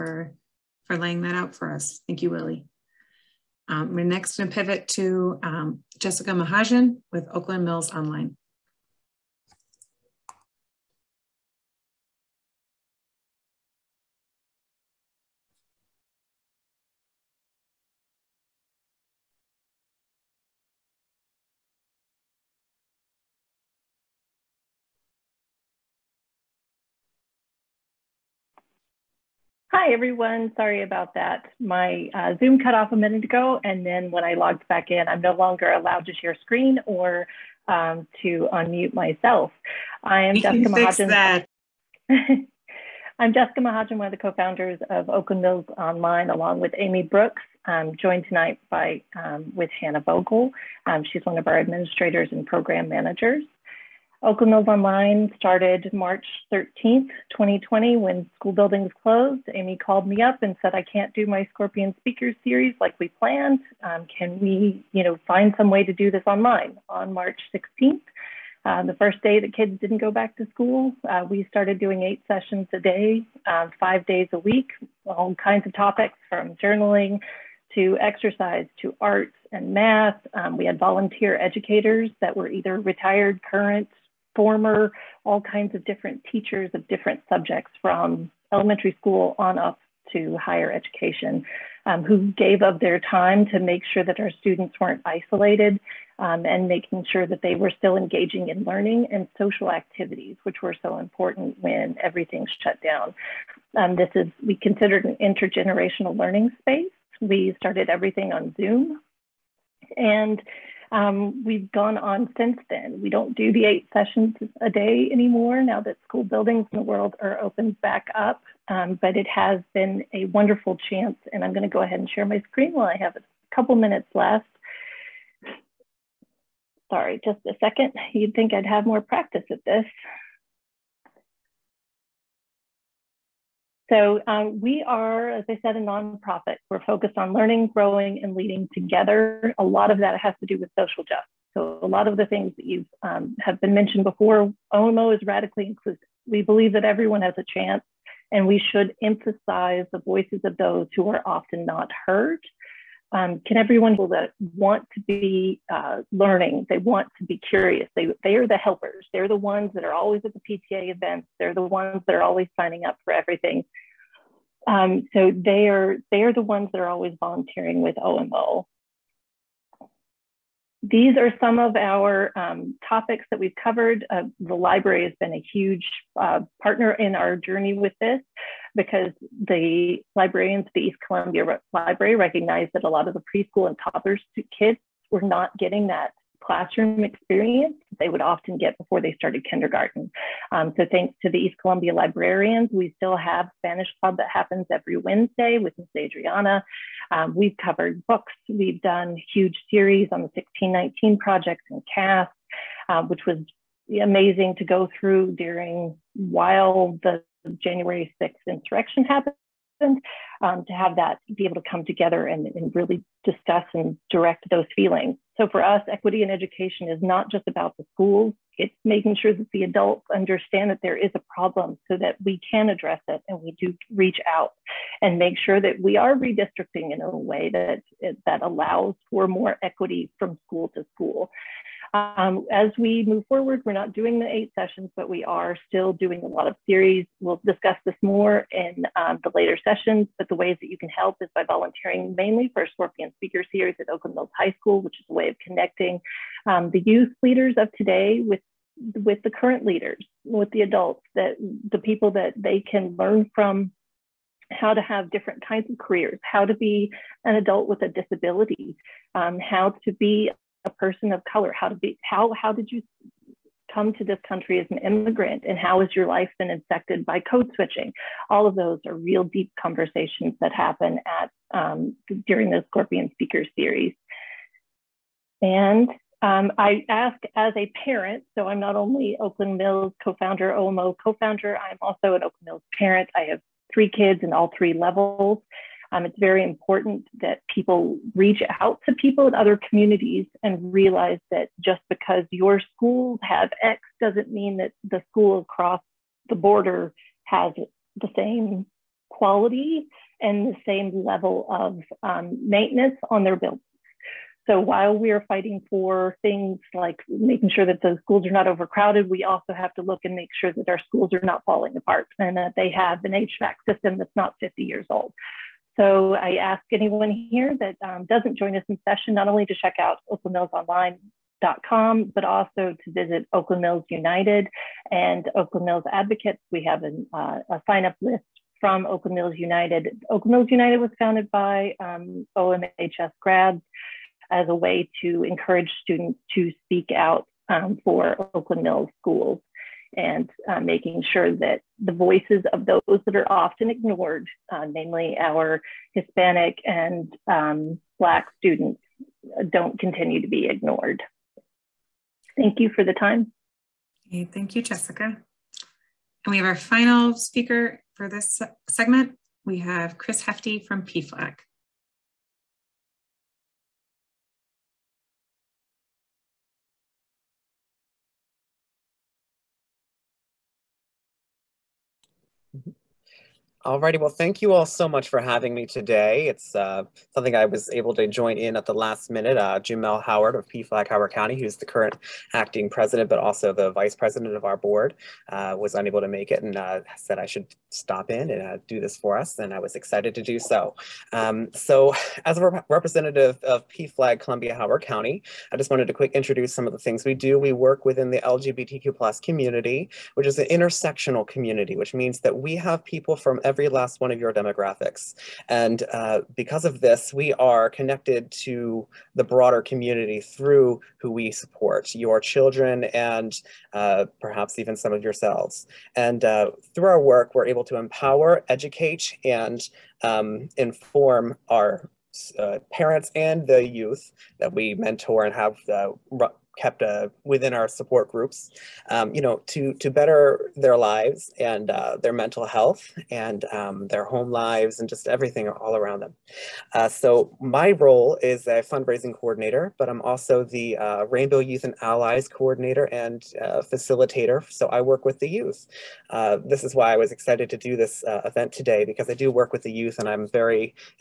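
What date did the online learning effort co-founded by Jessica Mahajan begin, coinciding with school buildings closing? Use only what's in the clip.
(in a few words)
March 13th, 2020.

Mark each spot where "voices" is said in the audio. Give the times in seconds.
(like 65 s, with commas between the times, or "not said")
150 s, 341 s.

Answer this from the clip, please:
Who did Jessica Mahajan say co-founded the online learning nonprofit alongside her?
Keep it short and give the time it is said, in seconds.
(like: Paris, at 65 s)
Amy Brooks, at 46 s.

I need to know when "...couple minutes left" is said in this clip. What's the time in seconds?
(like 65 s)
123 s.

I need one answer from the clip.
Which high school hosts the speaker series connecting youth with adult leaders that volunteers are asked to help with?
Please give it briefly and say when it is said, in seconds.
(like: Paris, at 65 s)
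Oakland Mills High School, at 243 s.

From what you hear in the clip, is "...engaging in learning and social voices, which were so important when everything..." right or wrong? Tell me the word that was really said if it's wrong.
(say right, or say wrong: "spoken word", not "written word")
wrong: "activities", not "voices".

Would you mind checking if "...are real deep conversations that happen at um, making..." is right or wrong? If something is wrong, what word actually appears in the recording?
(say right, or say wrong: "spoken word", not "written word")
wrong: "during", not "making".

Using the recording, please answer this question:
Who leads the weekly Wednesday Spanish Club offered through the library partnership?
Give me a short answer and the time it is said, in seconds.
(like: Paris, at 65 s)
Miss Adriana, at 195 s.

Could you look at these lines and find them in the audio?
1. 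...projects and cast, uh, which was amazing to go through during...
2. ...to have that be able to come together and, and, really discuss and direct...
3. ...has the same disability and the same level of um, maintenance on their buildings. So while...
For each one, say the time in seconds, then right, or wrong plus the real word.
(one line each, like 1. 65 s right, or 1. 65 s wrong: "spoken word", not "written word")
1. 201 s right
2. 210 s right
3. 297 s wrong: "quality", not "disability".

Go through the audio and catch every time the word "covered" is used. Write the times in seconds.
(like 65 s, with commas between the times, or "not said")
173 s, 197 s.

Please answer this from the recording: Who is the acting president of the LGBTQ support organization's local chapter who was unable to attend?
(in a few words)
Jamel Howard.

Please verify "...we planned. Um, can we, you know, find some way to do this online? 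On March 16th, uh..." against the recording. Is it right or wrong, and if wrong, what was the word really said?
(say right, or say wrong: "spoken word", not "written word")
right.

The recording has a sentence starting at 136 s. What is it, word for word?
We're focused on learning, growing, and leading together.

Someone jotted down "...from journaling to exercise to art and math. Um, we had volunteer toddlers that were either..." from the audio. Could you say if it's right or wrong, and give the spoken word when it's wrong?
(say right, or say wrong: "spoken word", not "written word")
wrong: "educators", not "toddlers".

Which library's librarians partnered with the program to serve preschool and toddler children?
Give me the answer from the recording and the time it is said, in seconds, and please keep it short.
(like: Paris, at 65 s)
East Columbia Library, at 180 s.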